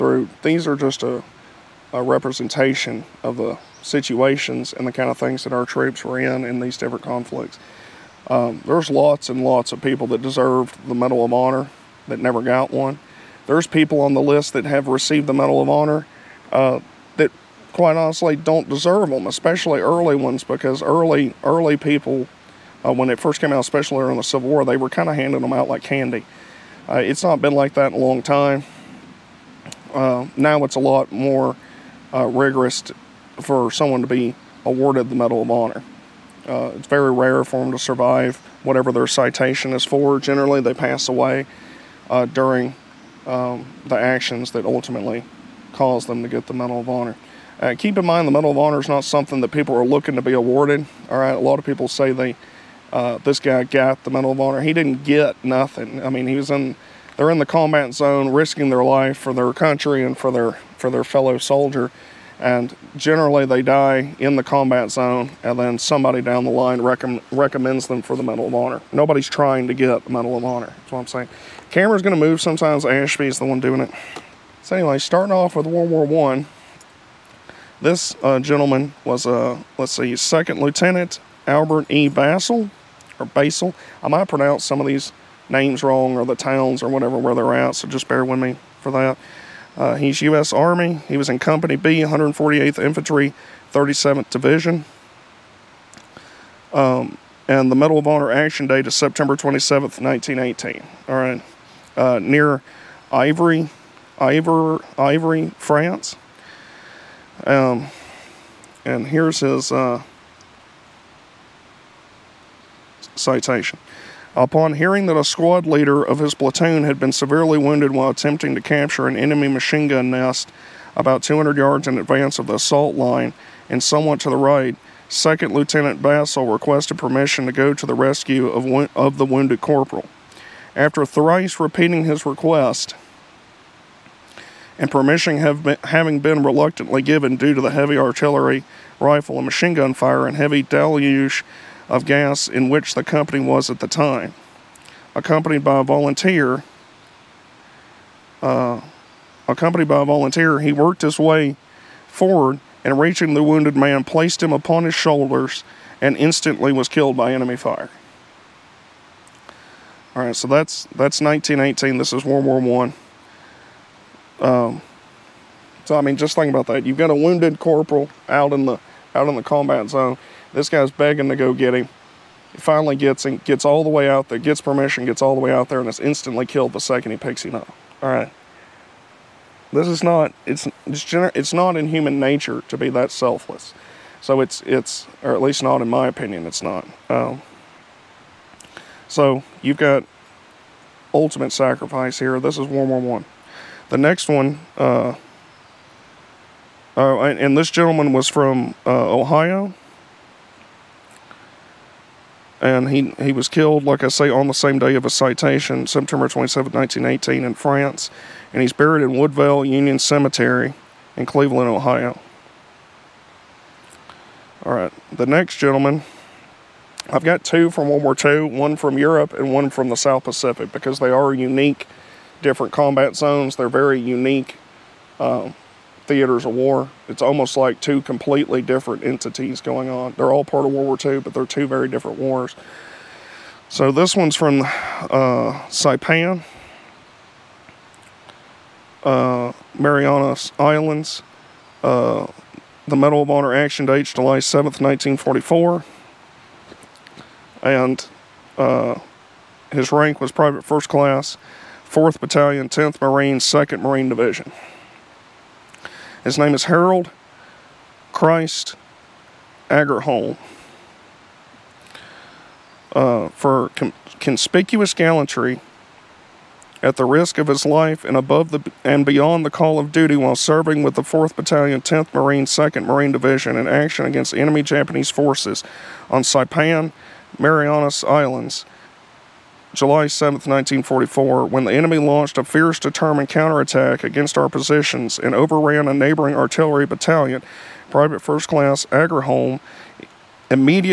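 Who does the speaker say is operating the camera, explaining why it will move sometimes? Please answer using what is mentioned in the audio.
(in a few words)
Ashby.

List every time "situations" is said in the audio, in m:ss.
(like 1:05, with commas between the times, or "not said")
0:03.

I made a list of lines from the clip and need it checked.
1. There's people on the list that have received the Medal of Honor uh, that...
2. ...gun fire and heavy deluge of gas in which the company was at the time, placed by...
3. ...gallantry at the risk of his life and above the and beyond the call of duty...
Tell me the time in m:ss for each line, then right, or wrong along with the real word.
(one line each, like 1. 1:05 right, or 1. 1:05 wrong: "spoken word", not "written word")
1. 0:13 right
2. 2:19 wrong: "accompanied", not "placed"
3. 4:24 right.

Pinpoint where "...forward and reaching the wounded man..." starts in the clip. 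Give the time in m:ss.
2:32.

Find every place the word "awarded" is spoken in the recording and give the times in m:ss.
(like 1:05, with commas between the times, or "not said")
0:34, 0:50.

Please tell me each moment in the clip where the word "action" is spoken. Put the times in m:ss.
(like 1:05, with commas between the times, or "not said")
0:43, 1:38, 4:03, 4:33.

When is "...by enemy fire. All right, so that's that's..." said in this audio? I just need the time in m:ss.
2:37.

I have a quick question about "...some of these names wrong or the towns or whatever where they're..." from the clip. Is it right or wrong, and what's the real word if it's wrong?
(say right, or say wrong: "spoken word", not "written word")
right.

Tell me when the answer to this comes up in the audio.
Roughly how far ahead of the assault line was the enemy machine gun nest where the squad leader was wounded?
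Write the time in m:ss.
2:01.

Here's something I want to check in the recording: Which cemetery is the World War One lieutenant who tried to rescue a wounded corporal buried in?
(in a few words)
Woodvale Union Cemetery.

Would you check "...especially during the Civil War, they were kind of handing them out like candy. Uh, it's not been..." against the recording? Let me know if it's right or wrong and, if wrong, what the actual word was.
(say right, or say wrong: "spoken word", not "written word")
right.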